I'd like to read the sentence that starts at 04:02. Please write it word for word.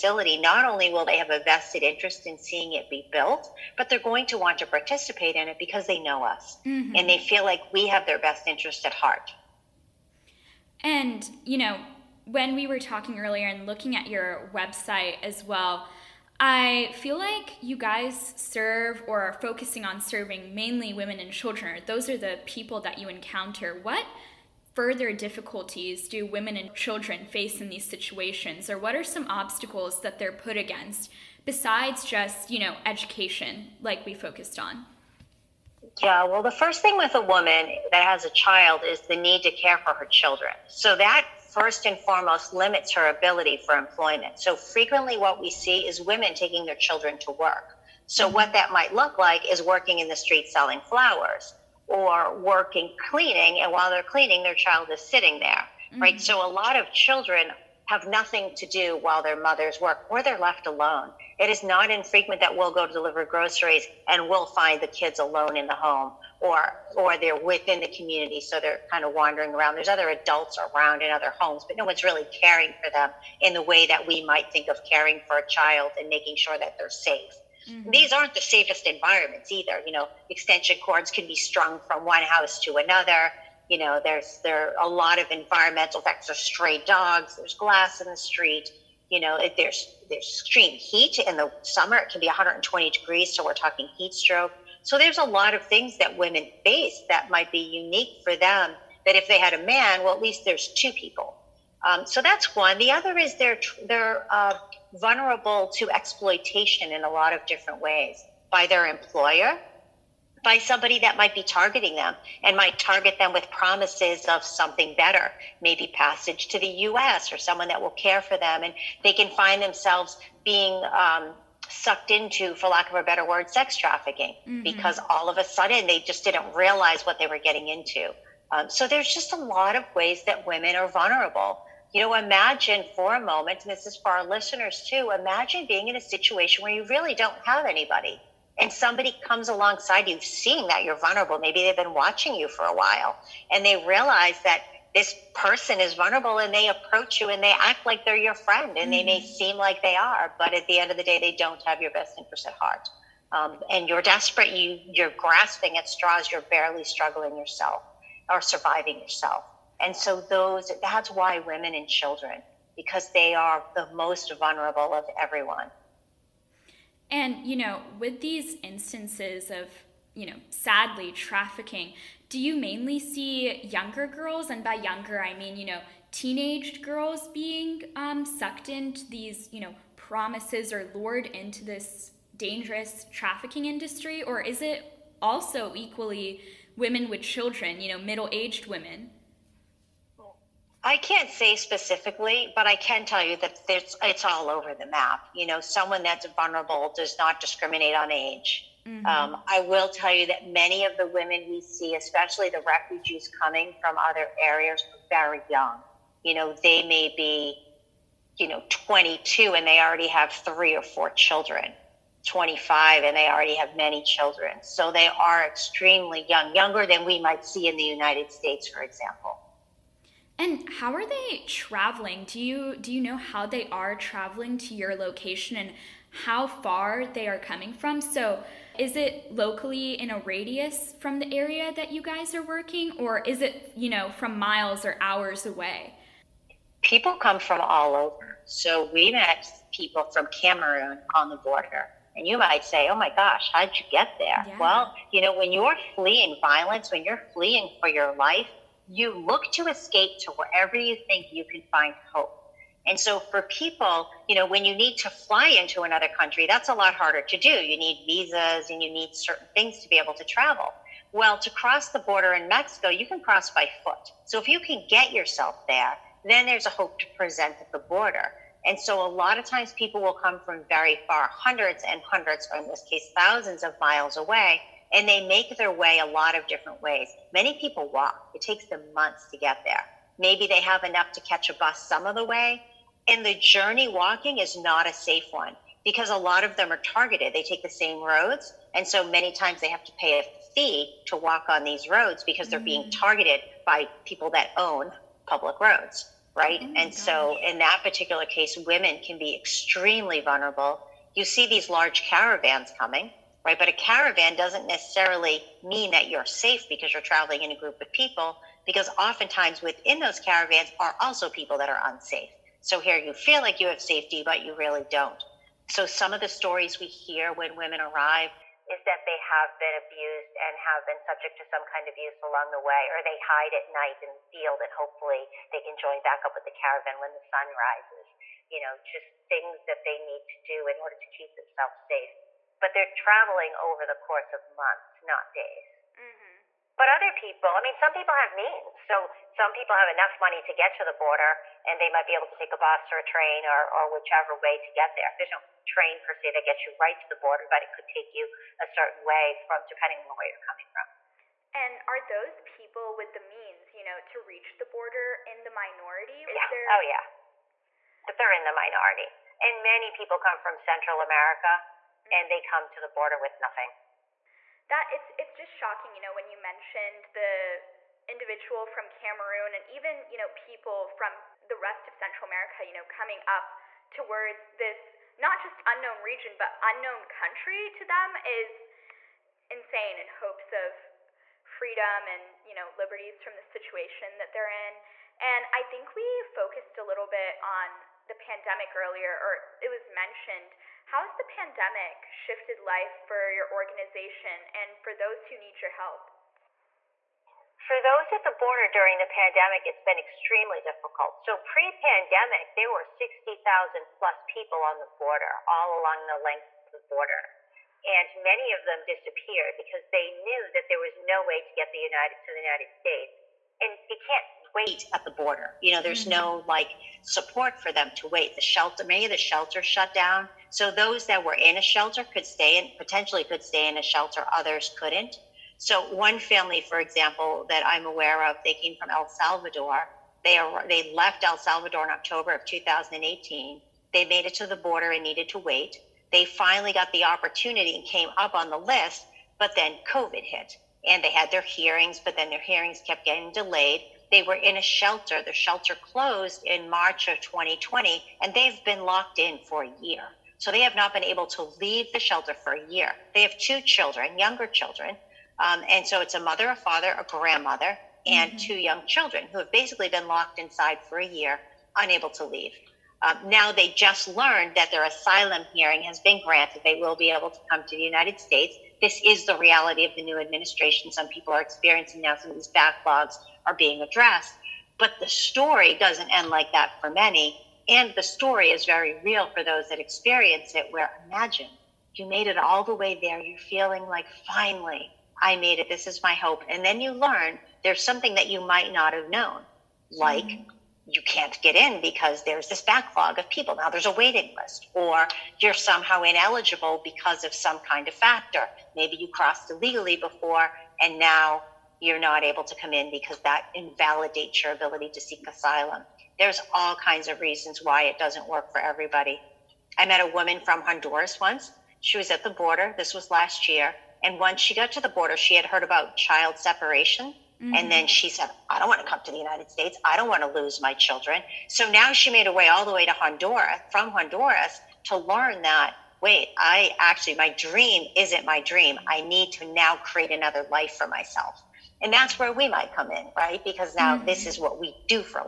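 And you might say, oh my gosh, how'd you get there?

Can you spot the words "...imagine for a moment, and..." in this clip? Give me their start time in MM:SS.
02:12.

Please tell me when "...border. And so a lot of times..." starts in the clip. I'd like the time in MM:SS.
04:27.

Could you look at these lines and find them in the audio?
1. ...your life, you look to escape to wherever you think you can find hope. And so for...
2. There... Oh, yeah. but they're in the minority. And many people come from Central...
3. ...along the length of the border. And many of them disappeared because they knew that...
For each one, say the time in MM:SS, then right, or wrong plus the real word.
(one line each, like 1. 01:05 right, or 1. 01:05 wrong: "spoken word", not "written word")
1. 04:07 right
2. 05:56 right
3. 06:45 right.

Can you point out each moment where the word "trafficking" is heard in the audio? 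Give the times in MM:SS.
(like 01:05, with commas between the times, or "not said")
02:03, 02:51, 03:03.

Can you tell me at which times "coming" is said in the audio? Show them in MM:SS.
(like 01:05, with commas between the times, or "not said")
03:23, 03:47, 05:02, 05:50, 06:12.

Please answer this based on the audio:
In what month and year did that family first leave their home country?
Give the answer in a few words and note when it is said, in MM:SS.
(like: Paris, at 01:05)
October 2018, at 07:11.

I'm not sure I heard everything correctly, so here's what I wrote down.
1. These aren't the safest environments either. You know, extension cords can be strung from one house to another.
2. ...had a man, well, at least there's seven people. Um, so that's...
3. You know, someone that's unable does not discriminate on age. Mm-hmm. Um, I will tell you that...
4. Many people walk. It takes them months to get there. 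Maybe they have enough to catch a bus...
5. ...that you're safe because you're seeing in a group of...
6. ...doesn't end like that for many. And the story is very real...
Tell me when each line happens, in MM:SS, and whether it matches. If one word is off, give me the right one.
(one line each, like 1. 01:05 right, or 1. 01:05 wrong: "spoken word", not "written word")
1. 01:17 right
2. 01:39 wrong: "two", not "seven"
3. 03:15 wrong: "vulnerable", not "unable"
4. 04:37 right
5. 05:05 wrong: "traveling", not "seeing"
6. 07:55 right.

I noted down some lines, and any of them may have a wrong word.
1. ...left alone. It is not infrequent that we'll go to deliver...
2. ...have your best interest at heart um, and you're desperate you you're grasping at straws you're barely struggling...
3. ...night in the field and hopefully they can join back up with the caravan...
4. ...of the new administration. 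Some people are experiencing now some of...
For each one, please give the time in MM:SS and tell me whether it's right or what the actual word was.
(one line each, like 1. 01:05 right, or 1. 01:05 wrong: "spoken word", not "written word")
1. 01:00 right
2. 02:31 right
3. 05:23 right
4. 07:49 right.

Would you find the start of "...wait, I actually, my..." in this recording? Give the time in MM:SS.
08:46.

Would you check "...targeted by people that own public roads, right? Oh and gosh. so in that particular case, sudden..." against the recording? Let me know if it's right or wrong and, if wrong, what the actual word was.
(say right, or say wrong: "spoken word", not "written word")
wrong: "women", not "sudden".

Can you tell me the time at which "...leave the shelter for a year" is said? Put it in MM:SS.
07:31.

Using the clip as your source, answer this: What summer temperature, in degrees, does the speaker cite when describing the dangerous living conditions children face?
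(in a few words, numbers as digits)
120.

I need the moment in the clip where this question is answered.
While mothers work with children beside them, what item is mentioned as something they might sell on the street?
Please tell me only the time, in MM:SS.
00:50.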